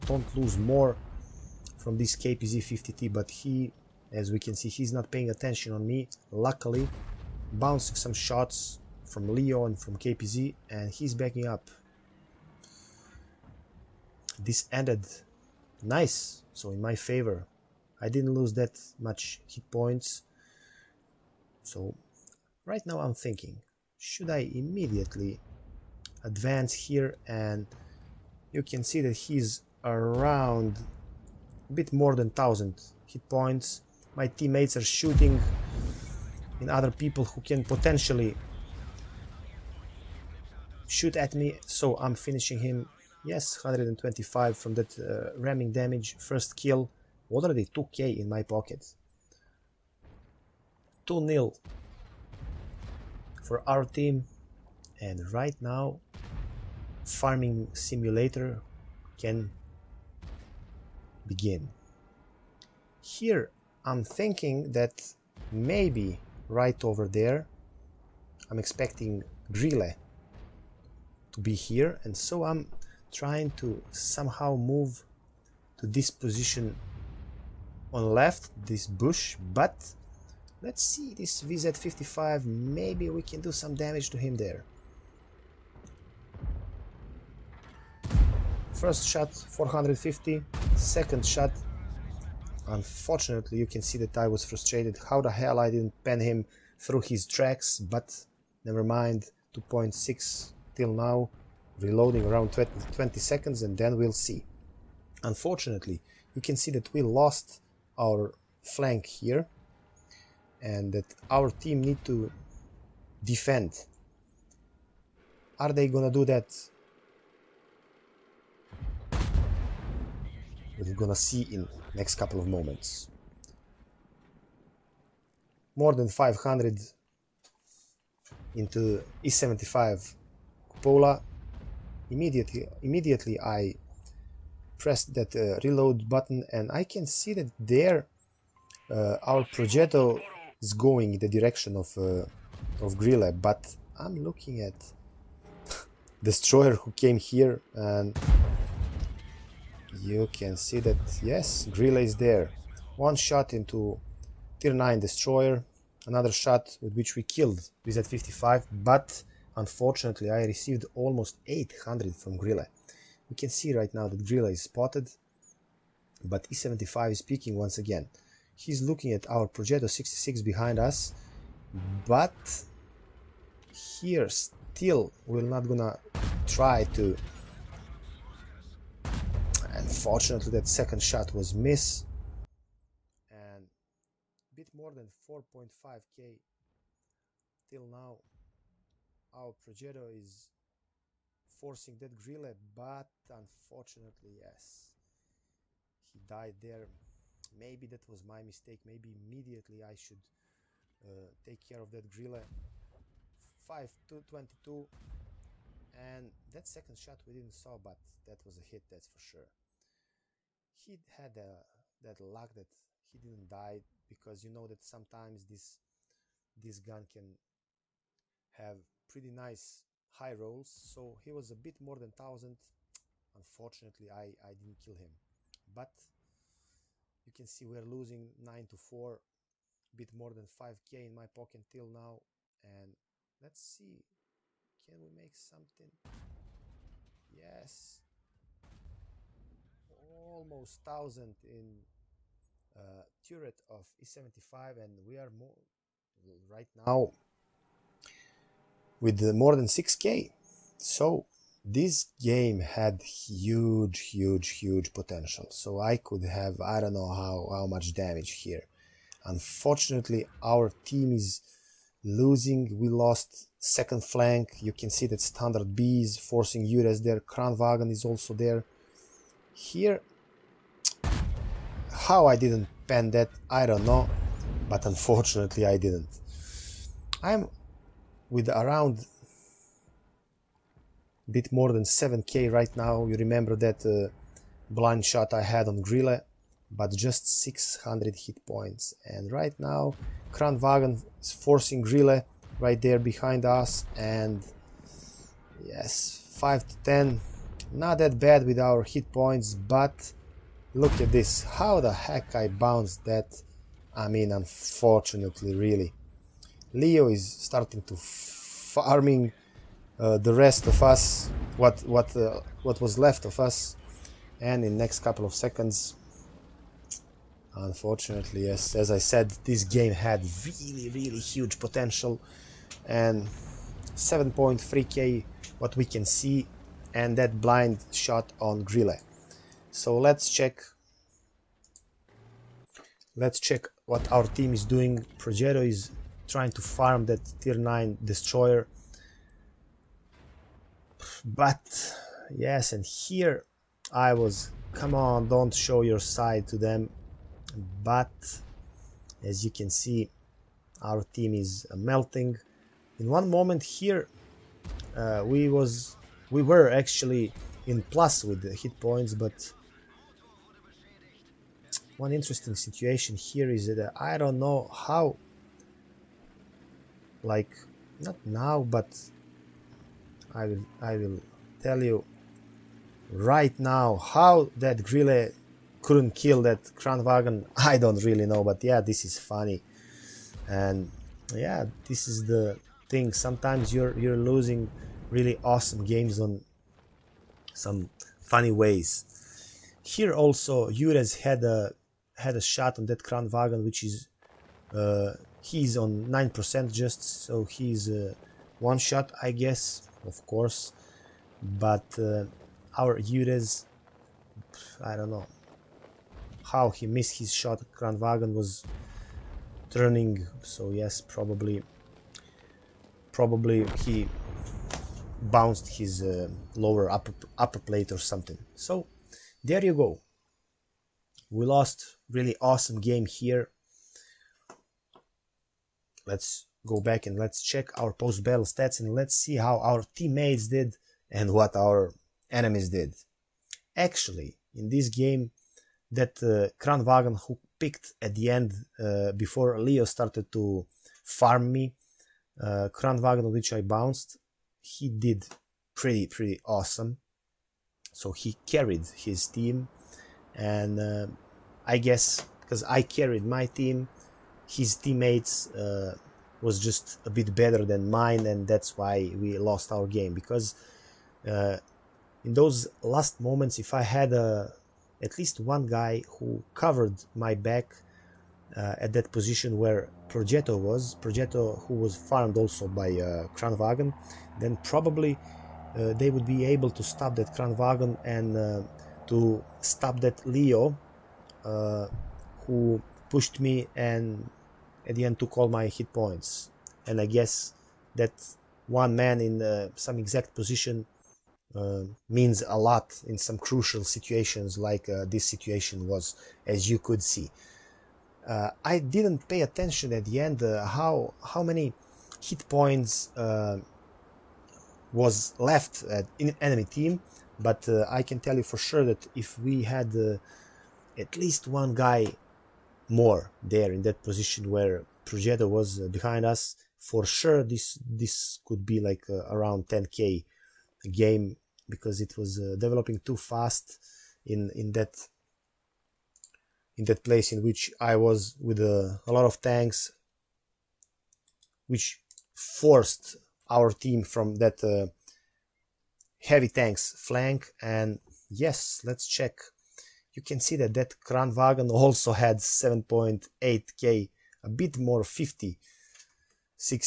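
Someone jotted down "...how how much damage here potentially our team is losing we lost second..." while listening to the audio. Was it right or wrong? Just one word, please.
wrong.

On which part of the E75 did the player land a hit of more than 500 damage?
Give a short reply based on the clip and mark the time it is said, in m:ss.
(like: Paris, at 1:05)
cupola, at 2:10.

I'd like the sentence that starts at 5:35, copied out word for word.
Progetto is trying to farm that tier 9 destroyer.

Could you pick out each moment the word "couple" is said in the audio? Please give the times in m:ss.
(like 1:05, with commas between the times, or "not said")
2:02, 5:14.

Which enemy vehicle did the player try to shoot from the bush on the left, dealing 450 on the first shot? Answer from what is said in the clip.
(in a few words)
VZ55.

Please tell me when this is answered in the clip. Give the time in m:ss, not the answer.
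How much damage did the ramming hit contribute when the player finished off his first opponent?
0:43.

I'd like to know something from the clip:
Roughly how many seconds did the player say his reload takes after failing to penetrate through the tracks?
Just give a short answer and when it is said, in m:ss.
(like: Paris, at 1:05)
20, at 1:42.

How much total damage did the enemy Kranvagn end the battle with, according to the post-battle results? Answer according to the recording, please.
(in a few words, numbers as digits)
7.8k.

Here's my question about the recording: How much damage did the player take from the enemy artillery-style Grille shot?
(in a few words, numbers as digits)
almost 800.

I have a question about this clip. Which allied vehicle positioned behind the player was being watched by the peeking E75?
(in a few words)
Progetto 66.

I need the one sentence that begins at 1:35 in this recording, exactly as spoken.
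How the hell I didn't pen him through his tracks, but never mind.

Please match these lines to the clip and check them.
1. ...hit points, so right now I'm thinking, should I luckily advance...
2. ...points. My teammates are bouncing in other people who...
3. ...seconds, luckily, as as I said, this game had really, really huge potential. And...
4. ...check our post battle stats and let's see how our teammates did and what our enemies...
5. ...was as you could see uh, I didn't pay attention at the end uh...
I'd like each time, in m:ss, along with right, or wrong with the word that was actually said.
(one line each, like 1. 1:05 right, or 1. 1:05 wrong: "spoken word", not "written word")
1. 0:19 wrong: "immediately", not "luckily"
2. 0:33 wrong: "shooting", not "bouncing"
3. 5:15 wrong: "unfortunately", not "luckily"
4. 7:07 right
5. 8:15 right.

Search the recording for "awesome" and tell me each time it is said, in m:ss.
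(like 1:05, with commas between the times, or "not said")
6:25, 7:02, 7:26.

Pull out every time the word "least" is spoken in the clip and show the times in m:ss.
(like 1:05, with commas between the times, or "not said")
7:45, 8:31.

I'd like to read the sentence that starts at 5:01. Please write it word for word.
How the heck I bounced that?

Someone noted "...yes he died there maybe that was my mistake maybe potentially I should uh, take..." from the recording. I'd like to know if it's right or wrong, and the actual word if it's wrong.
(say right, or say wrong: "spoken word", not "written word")
wrong: "immediately", not "potentially".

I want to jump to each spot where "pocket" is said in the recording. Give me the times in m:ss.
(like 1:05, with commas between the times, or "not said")
0:48, 3:51.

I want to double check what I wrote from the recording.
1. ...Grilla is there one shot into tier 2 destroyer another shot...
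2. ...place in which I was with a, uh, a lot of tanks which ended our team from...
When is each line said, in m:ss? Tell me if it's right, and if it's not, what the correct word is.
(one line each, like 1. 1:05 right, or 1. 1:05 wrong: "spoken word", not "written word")
1. 2:31 wrong: "9", not "2"
2. 8:47 wrong: "forced", not "ended".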